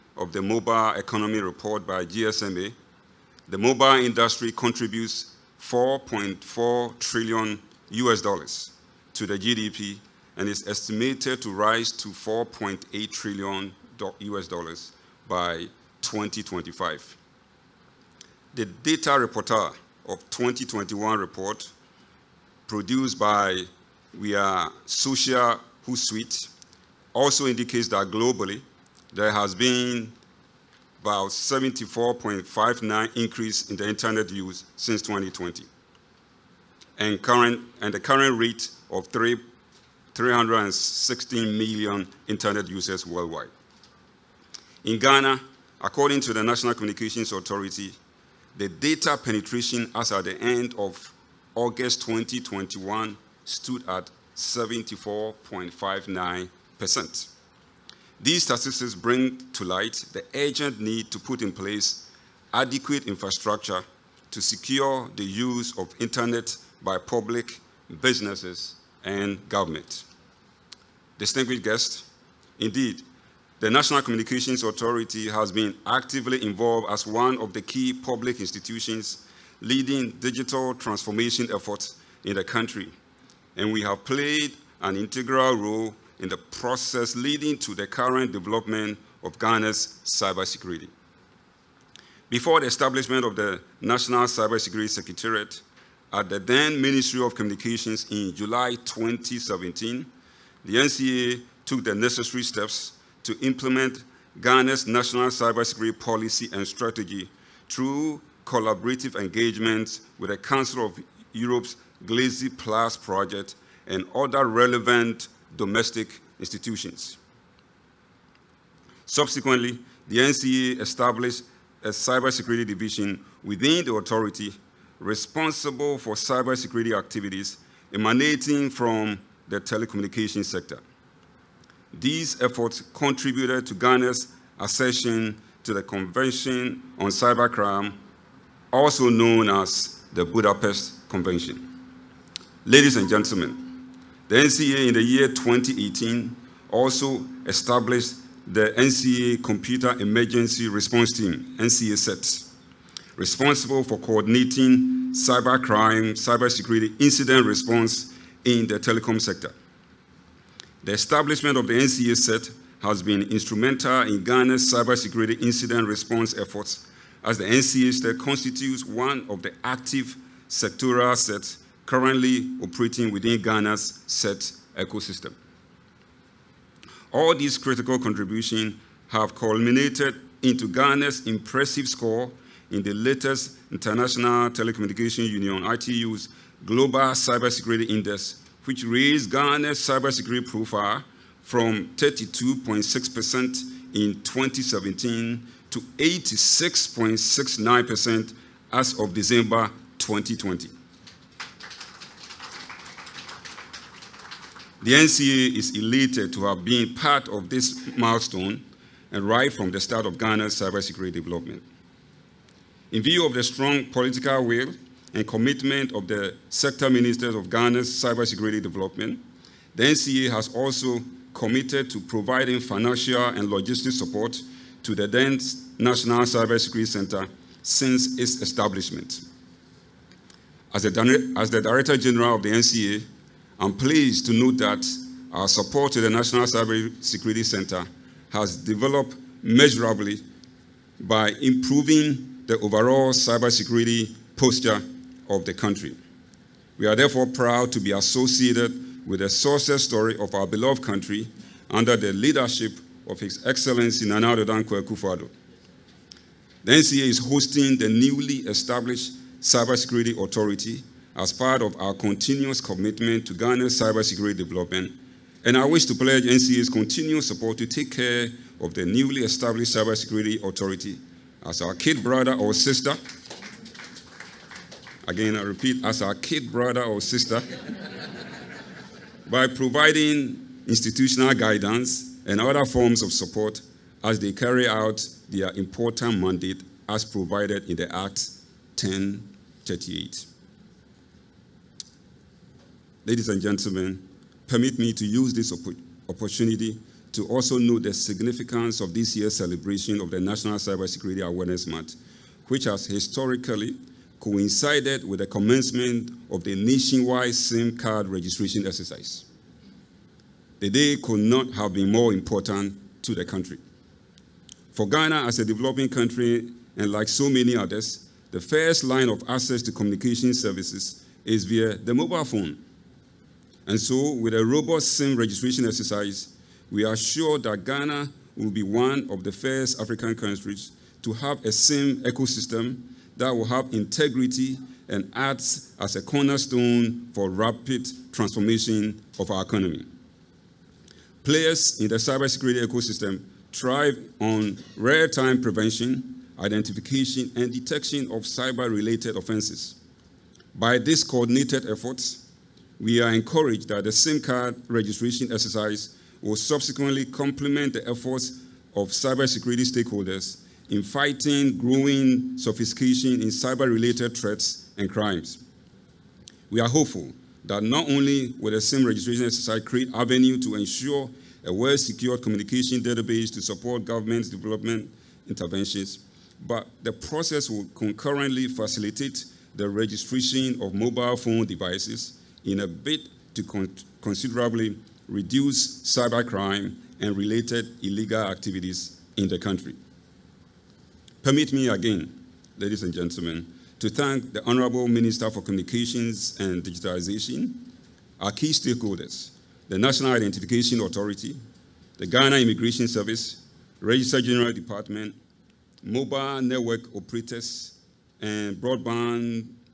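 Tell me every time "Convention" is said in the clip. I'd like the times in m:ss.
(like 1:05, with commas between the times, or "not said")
2:15, 2:21.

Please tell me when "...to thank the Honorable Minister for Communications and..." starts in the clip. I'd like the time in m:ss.
6:33.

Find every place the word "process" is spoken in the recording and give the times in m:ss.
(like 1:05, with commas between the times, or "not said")
1:26, 6:16.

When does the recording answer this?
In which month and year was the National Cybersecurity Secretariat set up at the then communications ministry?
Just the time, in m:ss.
1:38.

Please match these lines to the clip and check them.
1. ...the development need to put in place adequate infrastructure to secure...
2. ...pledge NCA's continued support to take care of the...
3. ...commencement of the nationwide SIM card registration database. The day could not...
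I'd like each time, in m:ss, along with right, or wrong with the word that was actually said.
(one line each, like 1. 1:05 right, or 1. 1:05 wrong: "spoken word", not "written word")
1. 1:00 wrong: "urgent", not "development"
2. 4:25 right
3. 5:05 wrong: "exercise", not "database".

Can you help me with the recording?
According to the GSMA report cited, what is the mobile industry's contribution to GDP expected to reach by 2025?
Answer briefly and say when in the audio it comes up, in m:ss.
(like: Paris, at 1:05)
4.8 trillion US dollars, at 0:12.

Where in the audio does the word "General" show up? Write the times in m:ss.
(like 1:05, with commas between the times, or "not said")
3:51, 6:44.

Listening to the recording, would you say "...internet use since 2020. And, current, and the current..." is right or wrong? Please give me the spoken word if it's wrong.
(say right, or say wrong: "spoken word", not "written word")
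right.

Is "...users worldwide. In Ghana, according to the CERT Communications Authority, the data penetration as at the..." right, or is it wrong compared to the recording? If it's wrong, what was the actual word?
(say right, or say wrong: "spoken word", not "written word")
wrong: "National", not "CERT".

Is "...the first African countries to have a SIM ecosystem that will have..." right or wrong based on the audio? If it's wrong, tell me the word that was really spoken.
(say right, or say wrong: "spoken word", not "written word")
right.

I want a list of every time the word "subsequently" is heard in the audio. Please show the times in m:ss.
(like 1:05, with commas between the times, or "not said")
1:59, 5:56.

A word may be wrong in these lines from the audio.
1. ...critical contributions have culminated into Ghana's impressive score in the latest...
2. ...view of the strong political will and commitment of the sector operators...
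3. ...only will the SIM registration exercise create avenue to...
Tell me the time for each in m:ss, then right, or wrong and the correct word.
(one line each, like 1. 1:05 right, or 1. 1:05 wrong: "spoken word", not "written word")
1. 2:57 right
2. 3:33 wrong: "ministers", not "operators"
3. 6:07 right.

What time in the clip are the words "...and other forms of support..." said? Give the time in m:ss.
4:42.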